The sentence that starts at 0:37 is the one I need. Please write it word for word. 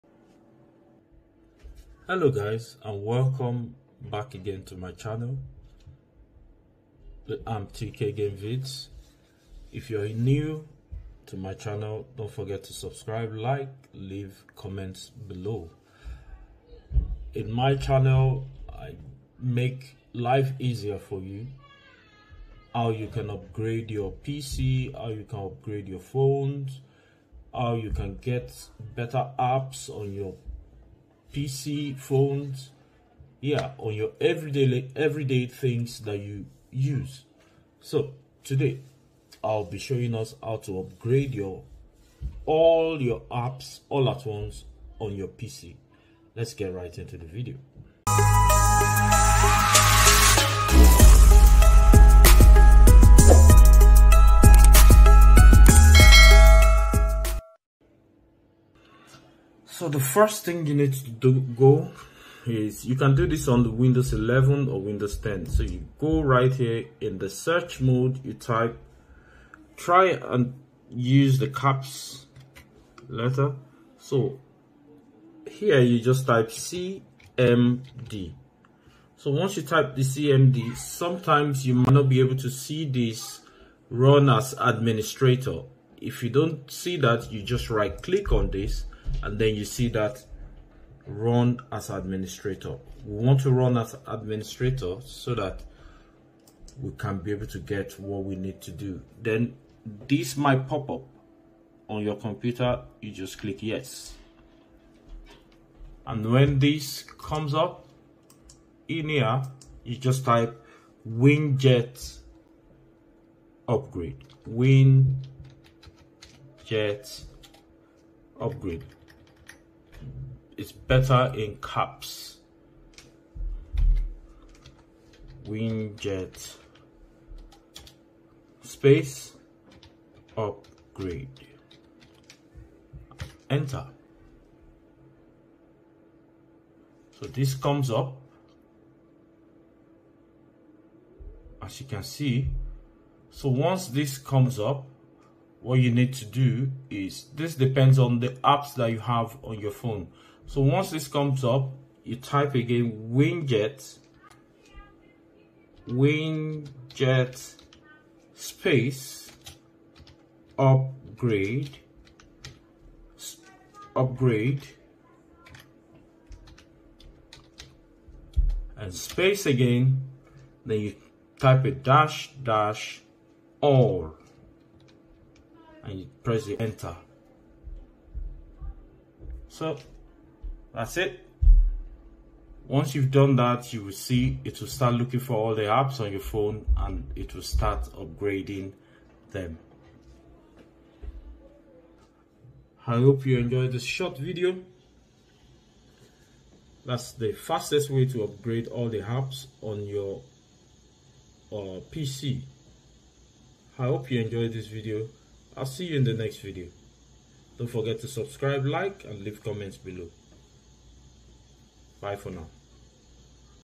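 So today, I'll be showing us how to upgrade your all your apps all at once on your PC.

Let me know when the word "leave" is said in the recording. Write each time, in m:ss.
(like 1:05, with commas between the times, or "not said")
0:13, 3:29.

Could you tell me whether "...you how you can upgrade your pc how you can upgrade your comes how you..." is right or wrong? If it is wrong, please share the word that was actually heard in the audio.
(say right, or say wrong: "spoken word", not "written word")
wrong: "phones", not "comes".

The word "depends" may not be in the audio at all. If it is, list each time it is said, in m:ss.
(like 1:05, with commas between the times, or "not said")
2:27.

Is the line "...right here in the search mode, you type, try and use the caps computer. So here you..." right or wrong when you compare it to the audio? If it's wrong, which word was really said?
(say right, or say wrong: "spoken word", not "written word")
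wrong: "letter", not "computer".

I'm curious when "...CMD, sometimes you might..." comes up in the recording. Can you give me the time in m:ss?
1:20.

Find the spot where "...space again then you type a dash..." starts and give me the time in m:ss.
2:48.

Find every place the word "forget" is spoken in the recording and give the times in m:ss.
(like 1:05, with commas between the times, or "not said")
0:12, 3:27.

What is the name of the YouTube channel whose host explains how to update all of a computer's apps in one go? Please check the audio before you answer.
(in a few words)
tk game vids.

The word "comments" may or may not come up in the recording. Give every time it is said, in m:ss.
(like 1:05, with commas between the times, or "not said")
0:14, 3:29.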